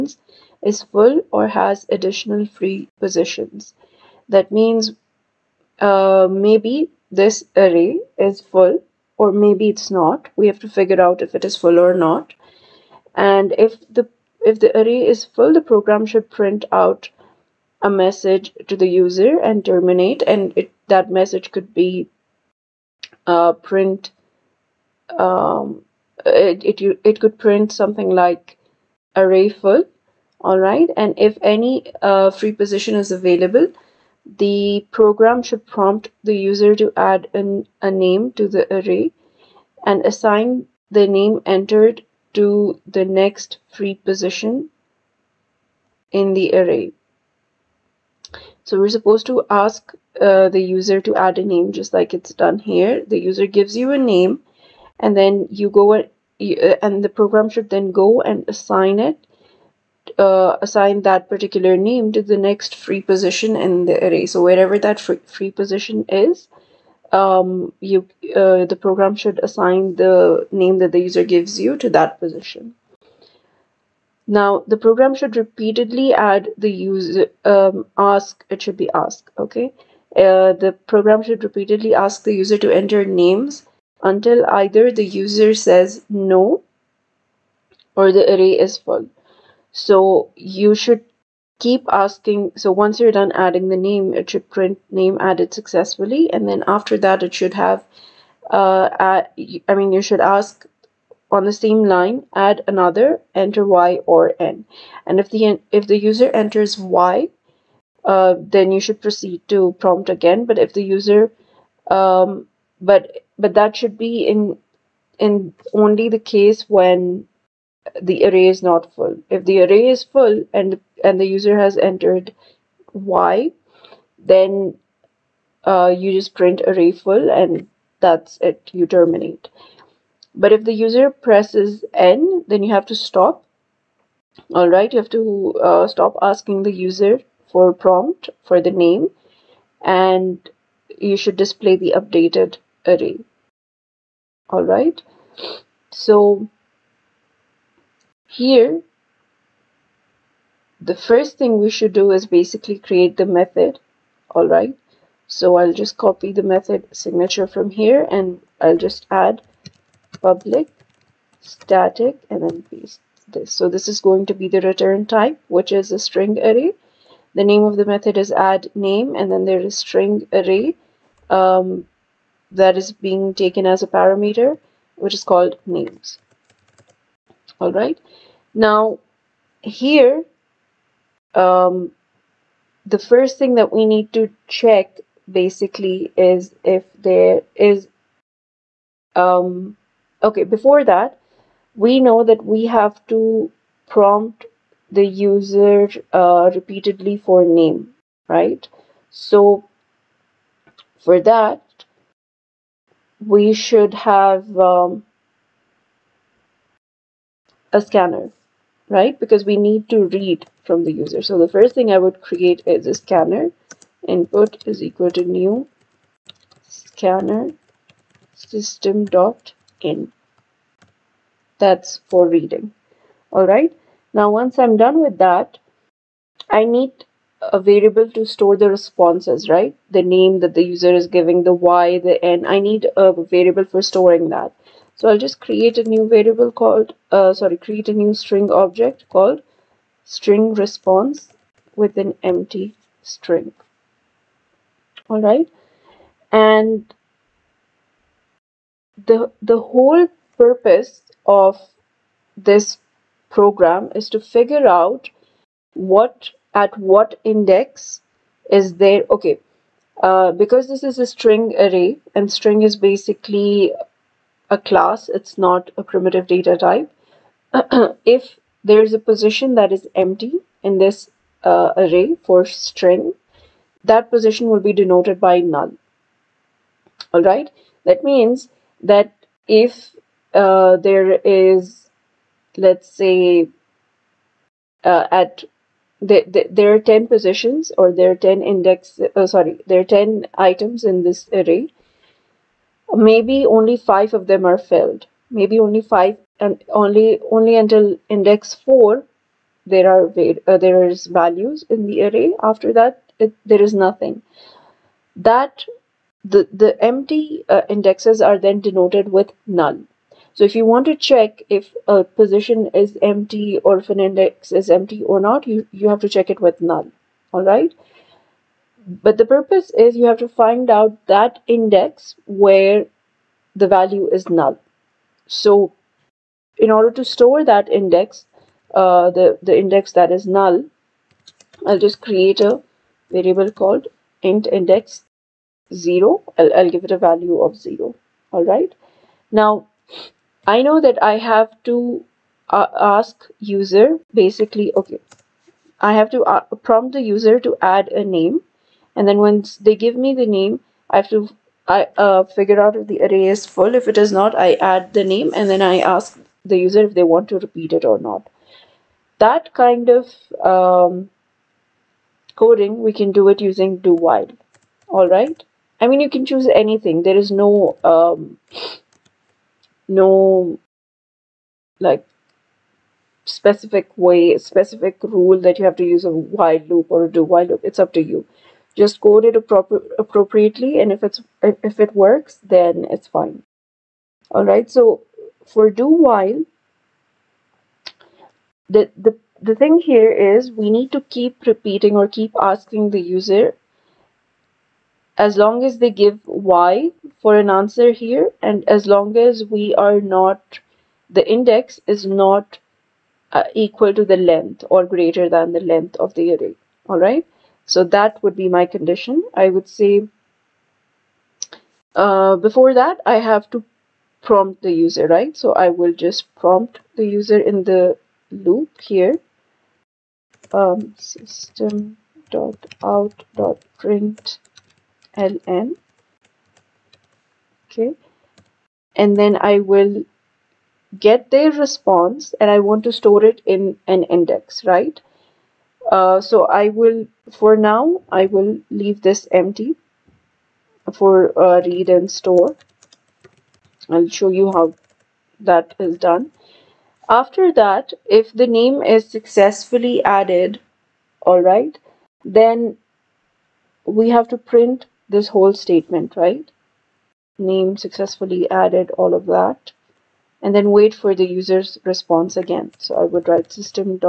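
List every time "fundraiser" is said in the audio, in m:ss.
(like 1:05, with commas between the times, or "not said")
not said.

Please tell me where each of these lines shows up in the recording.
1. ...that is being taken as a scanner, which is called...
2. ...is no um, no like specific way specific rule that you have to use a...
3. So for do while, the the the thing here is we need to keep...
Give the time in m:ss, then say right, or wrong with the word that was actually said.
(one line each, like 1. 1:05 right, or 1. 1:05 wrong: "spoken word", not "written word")
1. 2:52 wrong: "parameter", not "scanner"
2. 6:07 right
3. 6:24 right.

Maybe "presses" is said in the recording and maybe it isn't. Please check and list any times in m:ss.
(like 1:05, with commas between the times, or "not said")
2:11.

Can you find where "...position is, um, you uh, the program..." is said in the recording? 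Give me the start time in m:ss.
1:05.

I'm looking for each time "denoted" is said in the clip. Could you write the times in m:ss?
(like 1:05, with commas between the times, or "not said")
4:34, 5:08.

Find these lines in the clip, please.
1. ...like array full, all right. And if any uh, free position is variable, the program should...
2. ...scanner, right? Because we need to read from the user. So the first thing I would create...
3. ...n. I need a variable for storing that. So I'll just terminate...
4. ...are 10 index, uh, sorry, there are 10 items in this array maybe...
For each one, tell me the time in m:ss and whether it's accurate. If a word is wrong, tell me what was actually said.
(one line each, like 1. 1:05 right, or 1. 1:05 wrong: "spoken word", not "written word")
1. 0:28 wrong: "available", not "variable"
2. 3:27 right
3. 3:52 wrong: "create", not "terminate"
4. 4:48 right.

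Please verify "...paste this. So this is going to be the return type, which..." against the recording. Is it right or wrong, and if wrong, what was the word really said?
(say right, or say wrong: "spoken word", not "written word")
right.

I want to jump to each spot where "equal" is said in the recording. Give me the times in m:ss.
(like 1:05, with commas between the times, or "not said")
3:34, 6:43.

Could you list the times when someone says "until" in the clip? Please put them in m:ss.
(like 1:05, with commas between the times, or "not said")
1:24, 4:57.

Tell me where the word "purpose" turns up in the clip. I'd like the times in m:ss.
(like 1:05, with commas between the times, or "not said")
4:10, 5:19.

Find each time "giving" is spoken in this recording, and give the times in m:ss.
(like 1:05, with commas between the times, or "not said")
3:51.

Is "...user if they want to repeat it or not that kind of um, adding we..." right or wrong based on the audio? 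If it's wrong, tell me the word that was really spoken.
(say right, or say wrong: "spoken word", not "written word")
wrong: "coding", not "adding".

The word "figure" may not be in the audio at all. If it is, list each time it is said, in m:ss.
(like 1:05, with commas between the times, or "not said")
0:10, 4:14, 5:52.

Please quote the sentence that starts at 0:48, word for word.
So we're supposed to ask uh, the user to add a name just like it's done here.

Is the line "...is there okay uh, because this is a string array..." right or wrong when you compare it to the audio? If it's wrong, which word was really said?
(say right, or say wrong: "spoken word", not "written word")
right.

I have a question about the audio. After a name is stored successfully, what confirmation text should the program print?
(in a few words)
name added successfully.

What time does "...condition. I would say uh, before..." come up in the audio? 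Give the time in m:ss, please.
6:48.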